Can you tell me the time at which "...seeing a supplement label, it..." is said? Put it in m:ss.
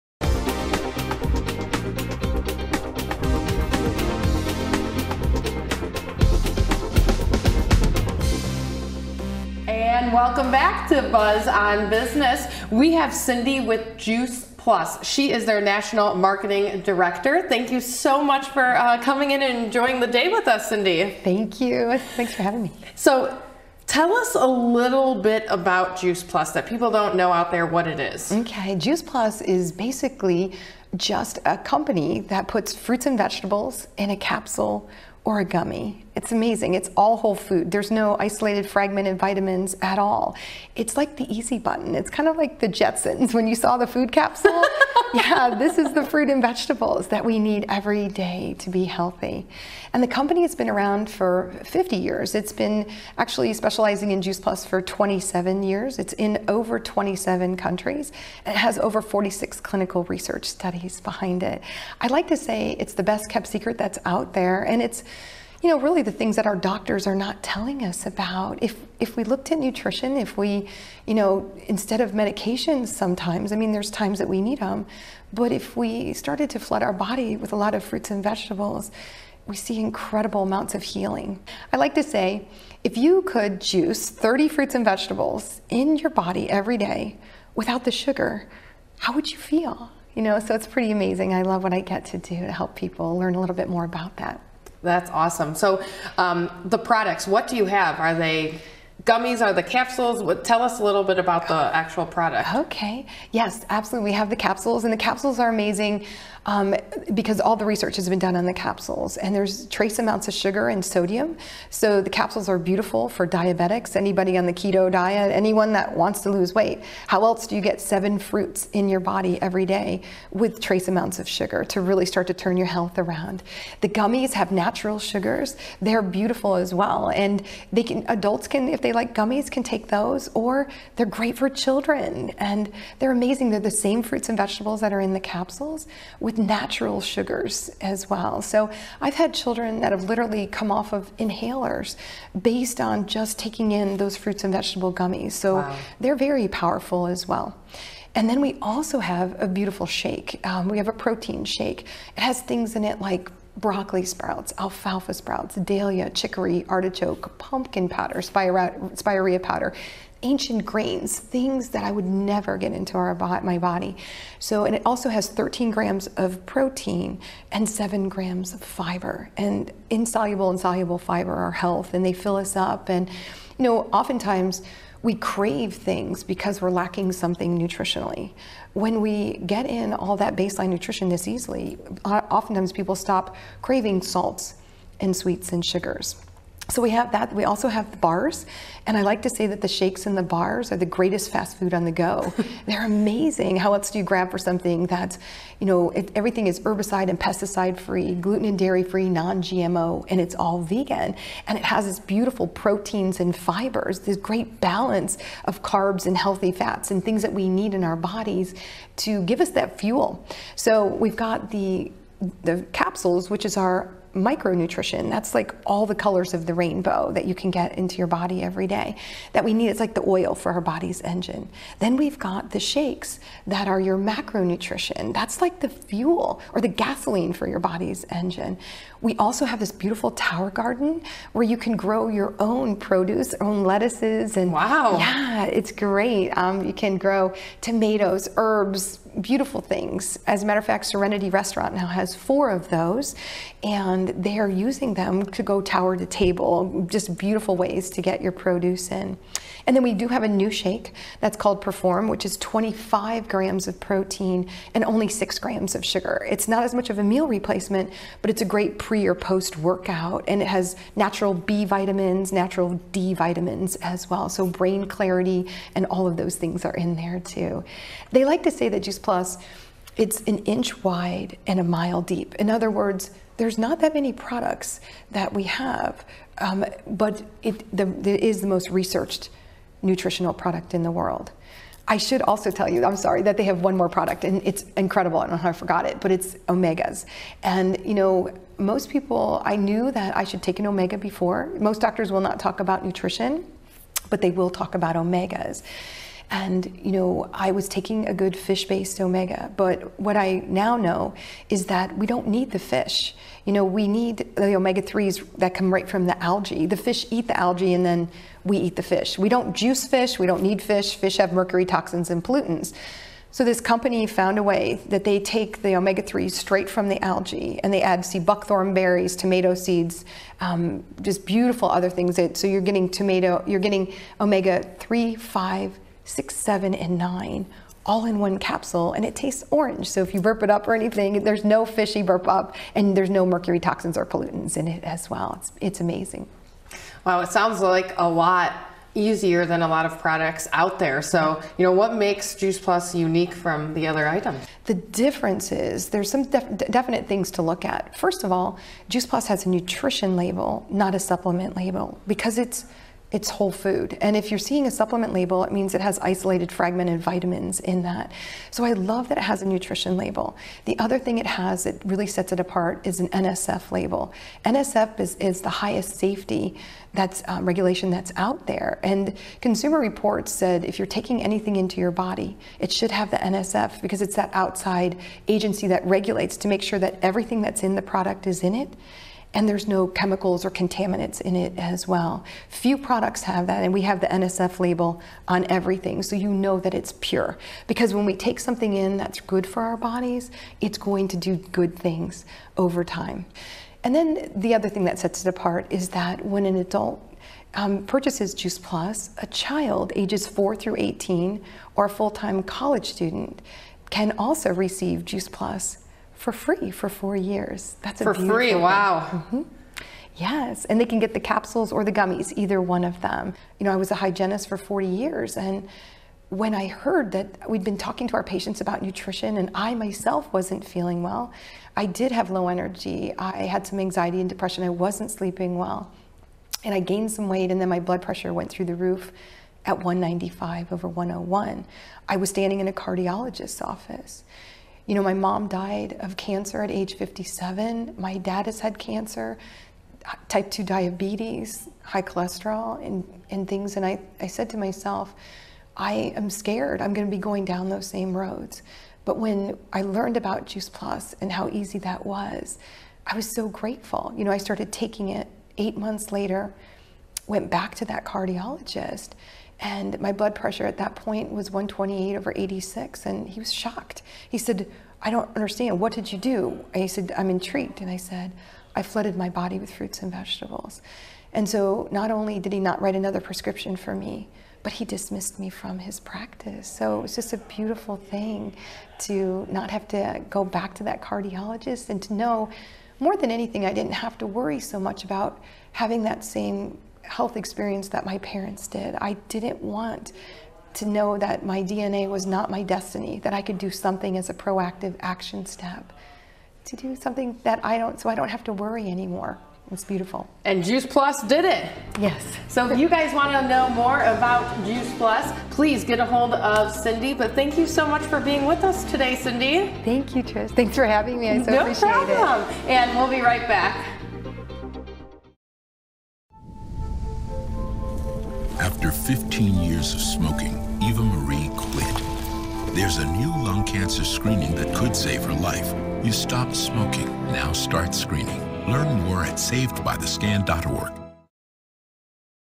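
5:54.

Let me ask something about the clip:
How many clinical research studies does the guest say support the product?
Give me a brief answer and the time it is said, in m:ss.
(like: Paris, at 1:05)
46, at 0:59.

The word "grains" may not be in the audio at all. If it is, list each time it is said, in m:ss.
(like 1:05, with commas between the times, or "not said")
2:40.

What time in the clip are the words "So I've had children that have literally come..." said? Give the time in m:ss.
2:18.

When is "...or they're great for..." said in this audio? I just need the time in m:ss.
2:10.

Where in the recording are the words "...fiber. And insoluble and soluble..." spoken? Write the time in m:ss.
2:48.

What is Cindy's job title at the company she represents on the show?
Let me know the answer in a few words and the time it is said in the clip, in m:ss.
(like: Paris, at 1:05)
National marketing director, at 0:15.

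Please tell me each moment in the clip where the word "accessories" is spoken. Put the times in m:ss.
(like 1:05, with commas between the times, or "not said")
not said.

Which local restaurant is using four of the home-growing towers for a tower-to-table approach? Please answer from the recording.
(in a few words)
Serenity Restaurant.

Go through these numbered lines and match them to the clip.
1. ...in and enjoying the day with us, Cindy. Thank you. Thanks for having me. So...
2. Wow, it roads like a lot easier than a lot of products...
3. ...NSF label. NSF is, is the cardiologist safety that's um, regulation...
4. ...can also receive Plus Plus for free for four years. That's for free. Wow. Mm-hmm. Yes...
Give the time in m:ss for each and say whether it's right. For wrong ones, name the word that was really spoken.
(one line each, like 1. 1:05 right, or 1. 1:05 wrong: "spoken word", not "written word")
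1. 0:19 right
2. 5:37 wrong: "sounds", not "roads"
3. 6:03 wrong: "highest", not "cardiologist"
4. 6:43 wrong: "Juice", not "Plus".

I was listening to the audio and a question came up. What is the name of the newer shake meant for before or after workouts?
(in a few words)
Perform.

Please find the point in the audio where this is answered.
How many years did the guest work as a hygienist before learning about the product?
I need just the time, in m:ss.
6:54.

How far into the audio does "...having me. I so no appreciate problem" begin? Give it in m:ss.
8:30.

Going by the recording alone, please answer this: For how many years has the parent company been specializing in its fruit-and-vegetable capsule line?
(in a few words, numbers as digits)
27.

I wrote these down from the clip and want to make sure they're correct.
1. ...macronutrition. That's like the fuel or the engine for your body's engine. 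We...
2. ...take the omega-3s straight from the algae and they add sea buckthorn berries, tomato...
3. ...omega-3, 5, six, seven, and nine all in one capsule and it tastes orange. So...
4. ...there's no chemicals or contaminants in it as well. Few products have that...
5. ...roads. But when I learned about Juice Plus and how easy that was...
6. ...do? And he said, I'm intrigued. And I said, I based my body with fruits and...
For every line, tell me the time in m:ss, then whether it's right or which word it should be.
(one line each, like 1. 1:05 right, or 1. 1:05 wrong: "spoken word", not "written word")
1. 3:43 wrong: "gasoline", not "engine"
2. 5:15 right
3. 5:24 right
4. 6:19 right
5. 7:28 right
6. 7:46 wrong: "flooded", not "based".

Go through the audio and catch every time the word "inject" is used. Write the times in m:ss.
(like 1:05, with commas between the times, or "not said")
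not said.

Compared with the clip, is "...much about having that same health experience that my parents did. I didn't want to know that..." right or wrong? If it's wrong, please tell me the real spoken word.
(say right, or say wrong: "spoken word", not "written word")
right.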